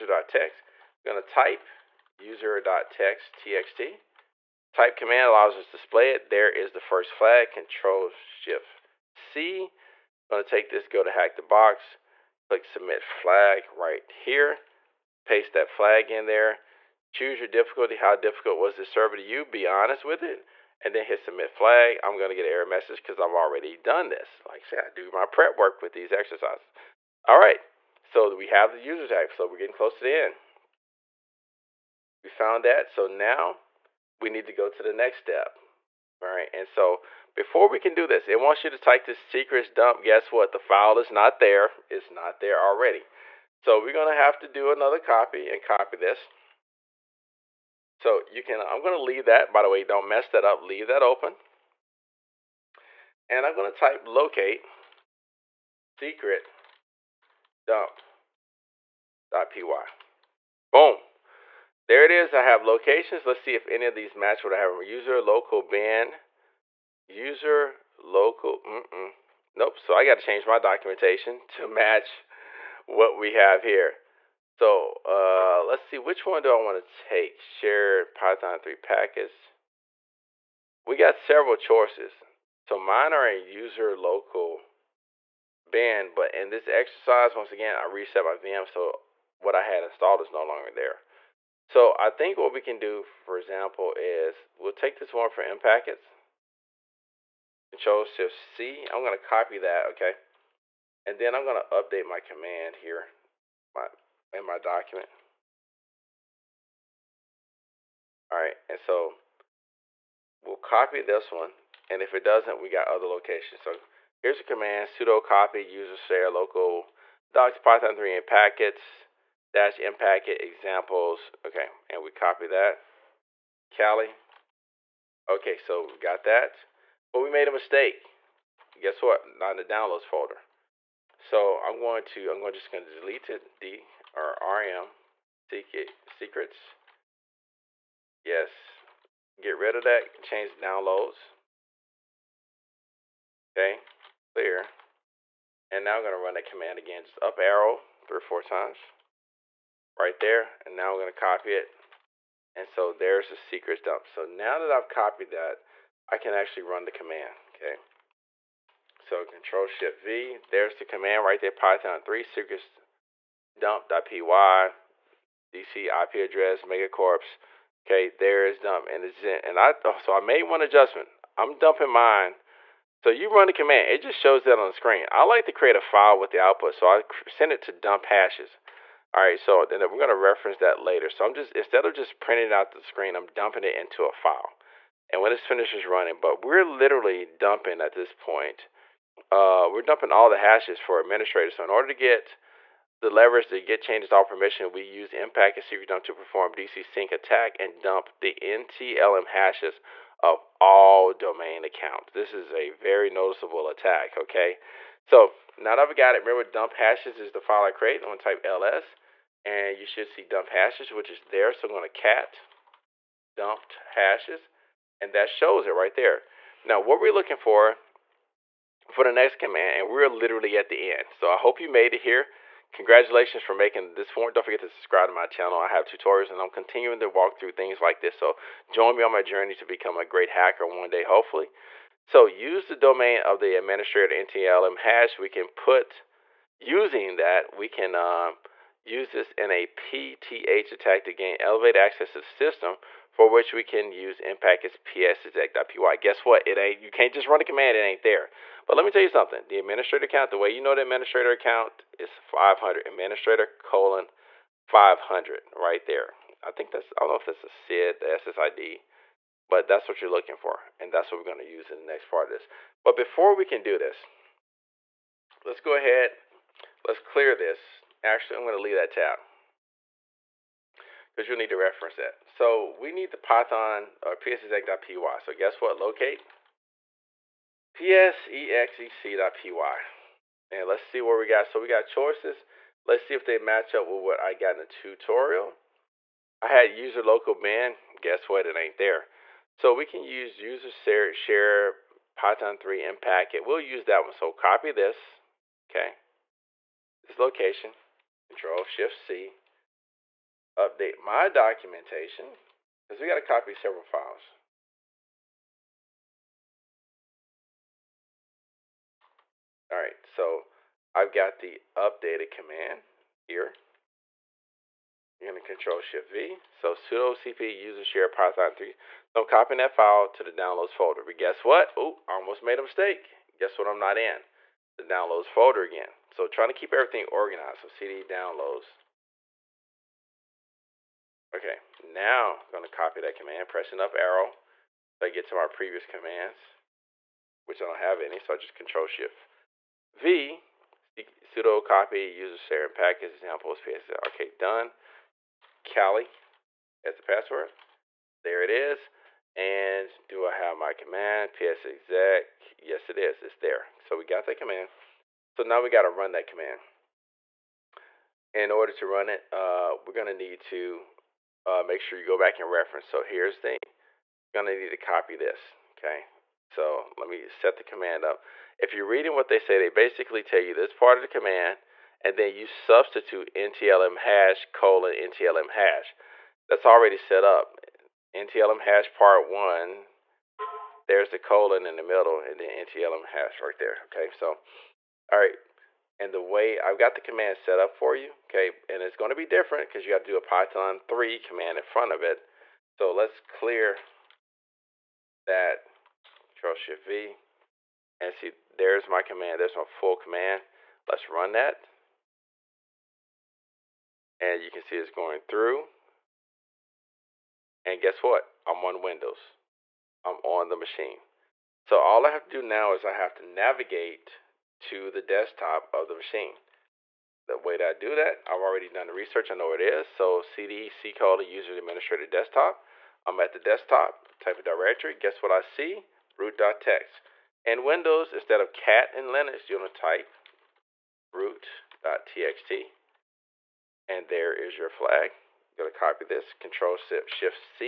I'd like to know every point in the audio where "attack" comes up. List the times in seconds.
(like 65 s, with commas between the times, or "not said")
197 s, 203 s, 240 s.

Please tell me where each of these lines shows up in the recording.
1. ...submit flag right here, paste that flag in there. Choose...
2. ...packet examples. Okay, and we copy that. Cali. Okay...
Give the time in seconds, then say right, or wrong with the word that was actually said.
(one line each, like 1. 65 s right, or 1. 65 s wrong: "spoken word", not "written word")
1. 12 s right
2. 119 s right.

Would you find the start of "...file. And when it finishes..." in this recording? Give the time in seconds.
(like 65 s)
184 s.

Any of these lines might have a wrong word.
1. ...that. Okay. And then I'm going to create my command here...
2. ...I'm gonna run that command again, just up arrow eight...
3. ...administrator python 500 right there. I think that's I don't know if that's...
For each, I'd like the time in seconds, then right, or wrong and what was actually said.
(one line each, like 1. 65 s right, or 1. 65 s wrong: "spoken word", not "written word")
1. 99 s wrong: "update", not "create"
2. 145 s wrong: "three", not "eight"
3. 252 s wrong: "colon", not "python".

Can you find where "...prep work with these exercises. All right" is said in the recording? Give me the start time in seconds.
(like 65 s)
25 s.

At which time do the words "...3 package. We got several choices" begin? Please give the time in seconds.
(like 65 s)
78 s.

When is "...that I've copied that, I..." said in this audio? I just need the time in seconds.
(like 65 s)
154 s.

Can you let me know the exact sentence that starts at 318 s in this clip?
So I'm copying that file to the downloads folder.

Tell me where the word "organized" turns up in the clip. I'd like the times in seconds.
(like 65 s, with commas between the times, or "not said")
327 s.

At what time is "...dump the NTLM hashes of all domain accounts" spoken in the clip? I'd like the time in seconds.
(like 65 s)
197 s.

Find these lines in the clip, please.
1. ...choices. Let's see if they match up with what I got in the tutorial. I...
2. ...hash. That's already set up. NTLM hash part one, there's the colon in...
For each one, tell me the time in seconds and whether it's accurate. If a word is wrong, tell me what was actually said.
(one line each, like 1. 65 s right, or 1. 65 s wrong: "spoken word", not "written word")
1. 281 s right
2. 375 s right.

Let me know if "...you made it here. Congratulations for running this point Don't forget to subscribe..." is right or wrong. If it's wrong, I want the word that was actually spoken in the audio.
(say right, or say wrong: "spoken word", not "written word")
wrong: "making", not "running".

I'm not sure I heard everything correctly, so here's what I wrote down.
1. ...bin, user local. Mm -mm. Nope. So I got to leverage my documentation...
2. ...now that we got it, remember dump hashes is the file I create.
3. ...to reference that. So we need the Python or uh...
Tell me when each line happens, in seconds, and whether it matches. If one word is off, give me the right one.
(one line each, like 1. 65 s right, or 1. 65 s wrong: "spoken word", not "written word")
1. 65 s wrong: "change", not "leverage"
2. 205 s right
3. 271 s right.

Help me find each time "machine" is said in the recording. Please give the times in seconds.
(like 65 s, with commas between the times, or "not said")
410 s, 415 s.